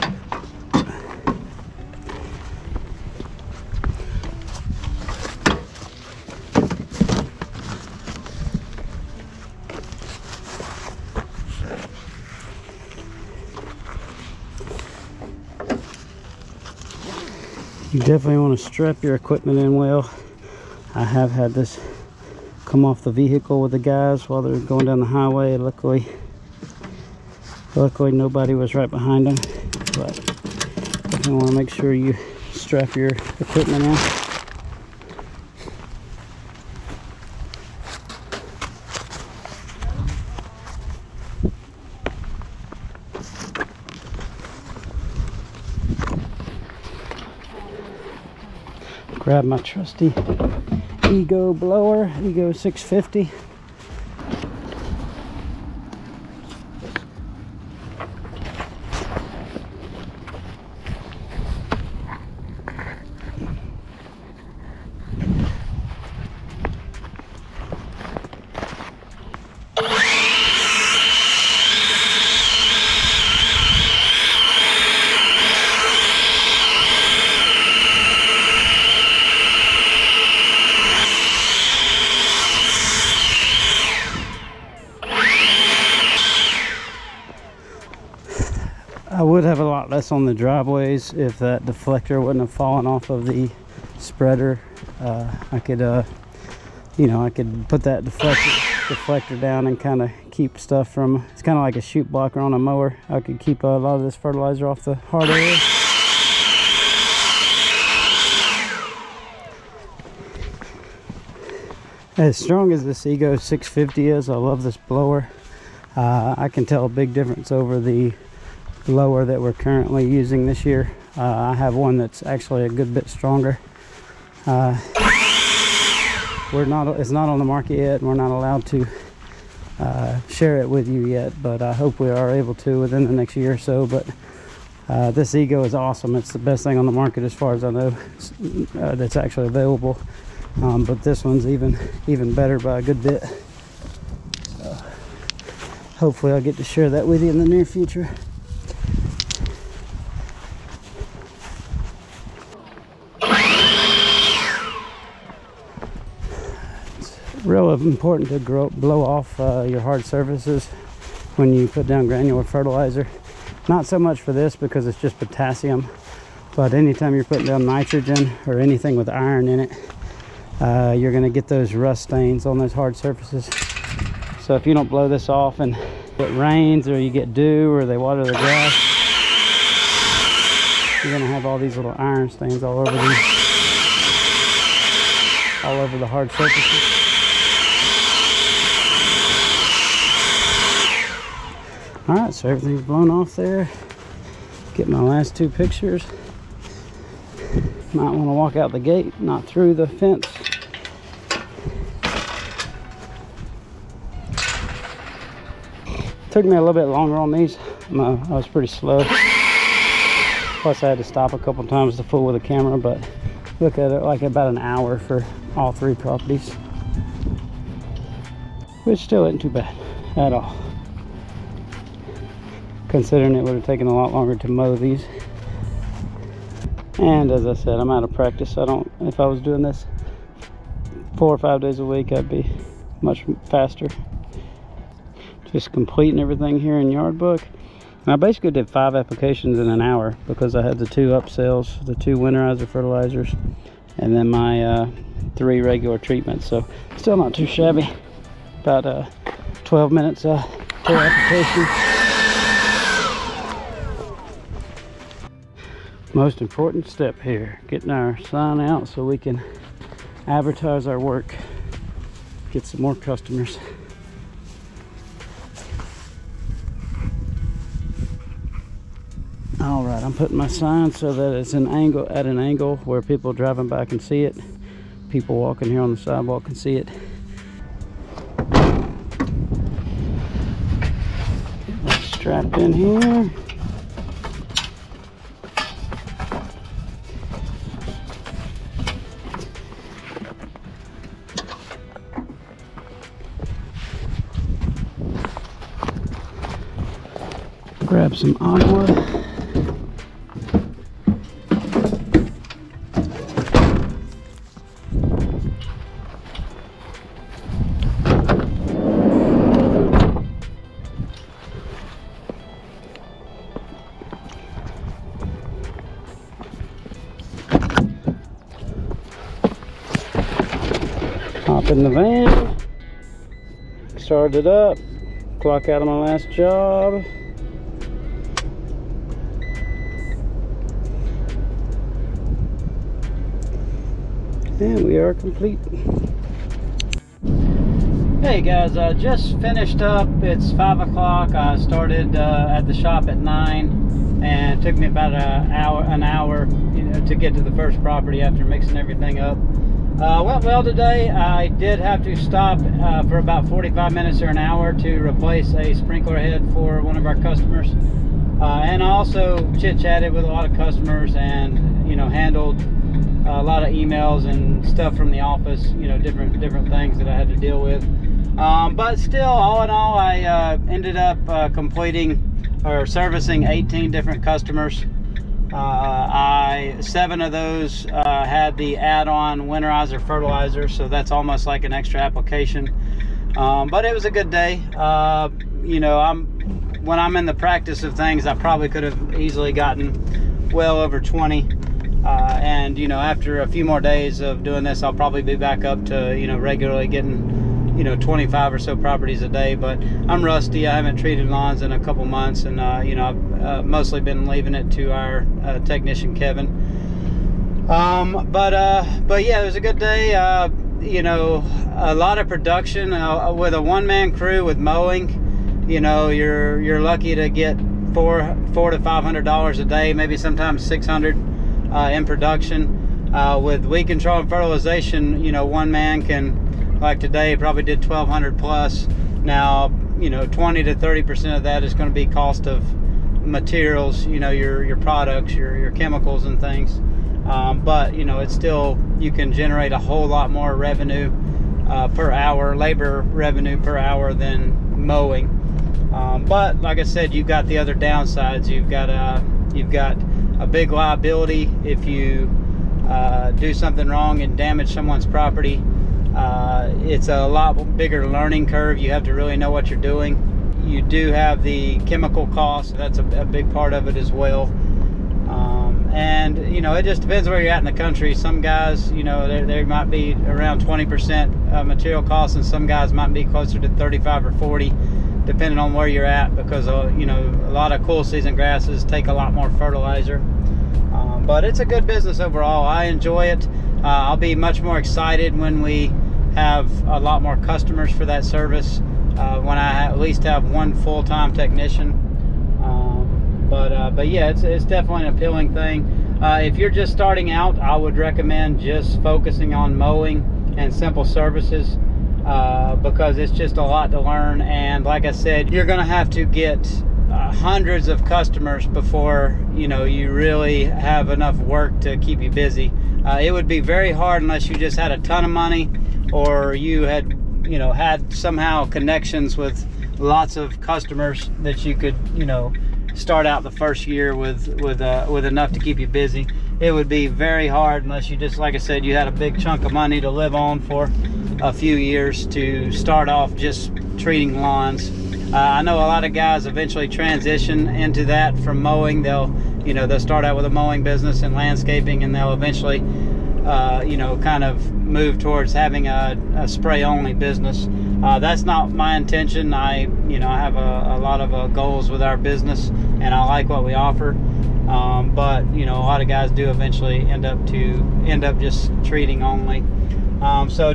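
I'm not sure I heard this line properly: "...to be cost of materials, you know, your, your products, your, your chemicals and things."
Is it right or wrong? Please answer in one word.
right.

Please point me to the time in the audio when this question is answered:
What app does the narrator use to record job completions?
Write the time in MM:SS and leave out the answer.
03:56.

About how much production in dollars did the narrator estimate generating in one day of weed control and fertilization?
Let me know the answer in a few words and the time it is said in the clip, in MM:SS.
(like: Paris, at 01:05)
1,200 plus, at 07:07.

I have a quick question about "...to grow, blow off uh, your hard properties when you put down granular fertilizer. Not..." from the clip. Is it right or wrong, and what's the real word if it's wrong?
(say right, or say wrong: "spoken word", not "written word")
wrong: "surfaces", not "properties".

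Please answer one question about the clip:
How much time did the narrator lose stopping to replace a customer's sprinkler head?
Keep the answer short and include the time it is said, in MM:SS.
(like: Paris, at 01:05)
45 minutes or an hour, at 05:53.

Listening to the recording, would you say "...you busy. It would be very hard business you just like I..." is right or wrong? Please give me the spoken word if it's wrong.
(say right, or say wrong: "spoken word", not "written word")
wrong: "unless", not "business".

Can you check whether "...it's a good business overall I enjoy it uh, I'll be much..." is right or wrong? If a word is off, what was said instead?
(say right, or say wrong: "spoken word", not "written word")
right.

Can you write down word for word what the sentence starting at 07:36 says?
Uh, it's a lot bigger learning curve.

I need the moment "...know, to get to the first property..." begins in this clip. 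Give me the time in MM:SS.
05:46.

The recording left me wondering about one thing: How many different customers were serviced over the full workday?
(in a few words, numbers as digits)
18.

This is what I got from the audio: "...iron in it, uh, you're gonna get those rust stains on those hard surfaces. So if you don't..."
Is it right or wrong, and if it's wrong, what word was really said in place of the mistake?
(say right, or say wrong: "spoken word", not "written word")
right.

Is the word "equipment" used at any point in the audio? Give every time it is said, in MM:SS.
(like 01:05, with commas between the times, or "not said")
00:19, 00:33.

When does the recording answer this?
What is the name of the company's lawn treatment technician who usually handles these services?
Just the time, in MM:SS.
06:46.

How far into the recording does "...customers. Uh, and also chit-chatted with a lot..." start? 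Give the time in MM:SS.
05:57.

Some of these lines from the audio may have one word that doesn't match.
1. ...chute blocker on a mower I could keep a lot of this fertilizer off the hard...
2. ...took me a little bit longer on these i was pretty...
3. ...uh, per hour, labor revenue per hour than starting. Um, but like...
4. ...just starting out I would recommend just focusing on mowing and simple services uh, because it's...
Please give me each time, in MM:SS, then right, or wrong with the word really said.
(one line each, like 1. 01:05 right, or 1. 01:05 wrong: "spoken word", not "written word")
1. 01:41 right
2. 03:26 right
3. 07:21 wrong: "mowing", not "starting"
4. 08:16 right.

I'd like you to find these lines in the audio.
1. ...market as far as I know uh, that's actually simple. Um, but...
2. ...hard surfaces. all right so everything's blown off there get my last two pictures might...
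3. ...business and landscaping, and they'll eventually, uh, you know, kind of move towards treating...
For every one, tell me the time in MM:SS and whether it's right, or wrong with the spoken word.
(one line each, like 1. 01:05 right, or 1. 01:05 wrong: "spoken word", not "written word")
1. 02:16 wrong: "available", not "simple"
2. 03:06 right
3. 09:00 wrong: "having", not "treating".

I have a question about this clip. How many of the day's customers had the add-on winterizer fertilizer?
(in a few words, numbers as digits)
7.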